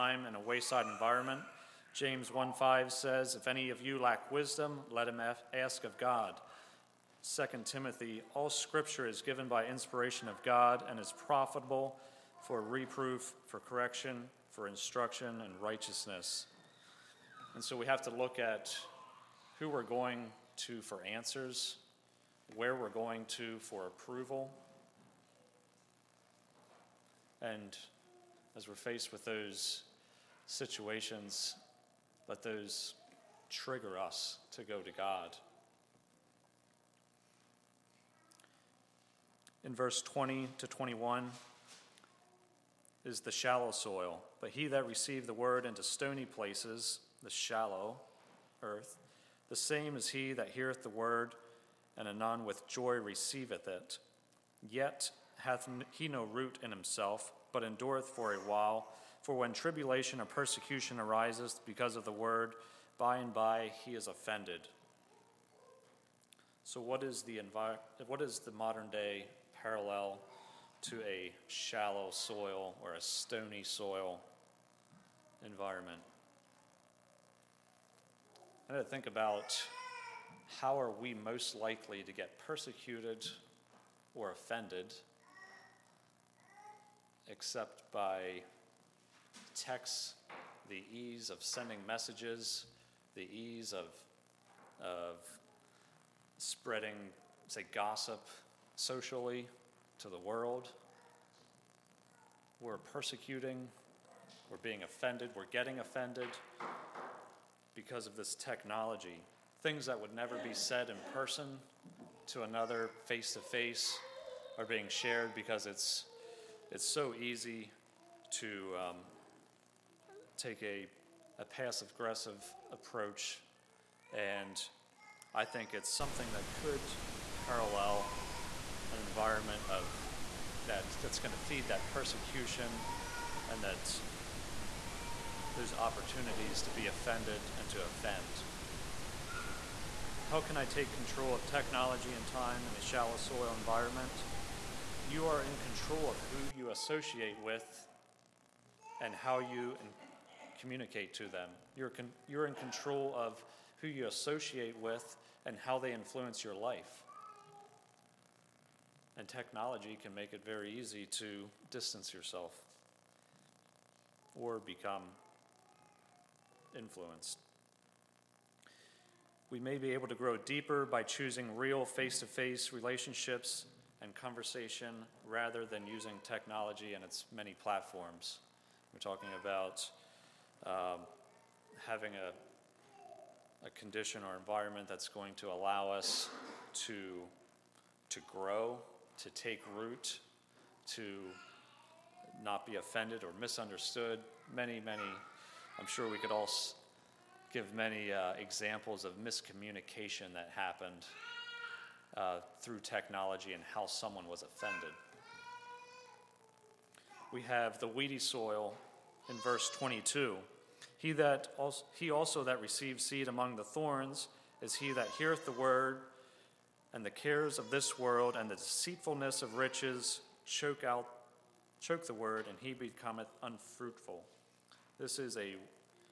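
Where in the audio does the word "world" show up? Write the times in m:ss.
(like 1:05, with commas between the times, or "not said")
1:40, 3:37.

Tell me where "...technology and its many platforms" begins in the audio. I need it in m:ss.
2:56.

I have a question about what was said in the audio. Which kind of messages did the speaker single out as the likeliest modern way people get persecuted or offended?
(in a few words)
Texts.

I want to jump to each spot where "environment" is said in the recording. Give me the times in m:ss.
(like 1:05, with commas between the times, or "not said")
0:00, 1:15, 2:08, 2:23, 3:04.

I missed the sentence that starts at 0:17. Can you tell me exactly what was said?
And so we have to look at who we're going to for answers, where we're going to for approval.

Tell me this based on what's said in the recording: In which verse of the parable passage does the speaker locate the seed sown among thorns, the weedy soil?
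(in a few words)
Verse 22.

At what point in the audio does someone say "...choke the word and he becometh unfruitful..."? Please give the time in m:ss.
3:41.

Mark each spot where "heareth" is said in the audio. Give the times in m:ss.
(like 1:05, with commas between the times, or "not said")
0:50, 3:35.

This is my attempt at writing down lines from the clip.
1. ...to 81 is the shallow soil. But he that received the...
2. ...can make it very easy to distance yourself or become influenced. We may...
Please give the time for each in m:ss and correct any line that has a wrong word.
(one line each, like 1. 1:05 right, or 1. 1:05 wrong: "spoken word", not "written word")
1. 0:40 wrong: "21", not "81"
2. 2:40 right.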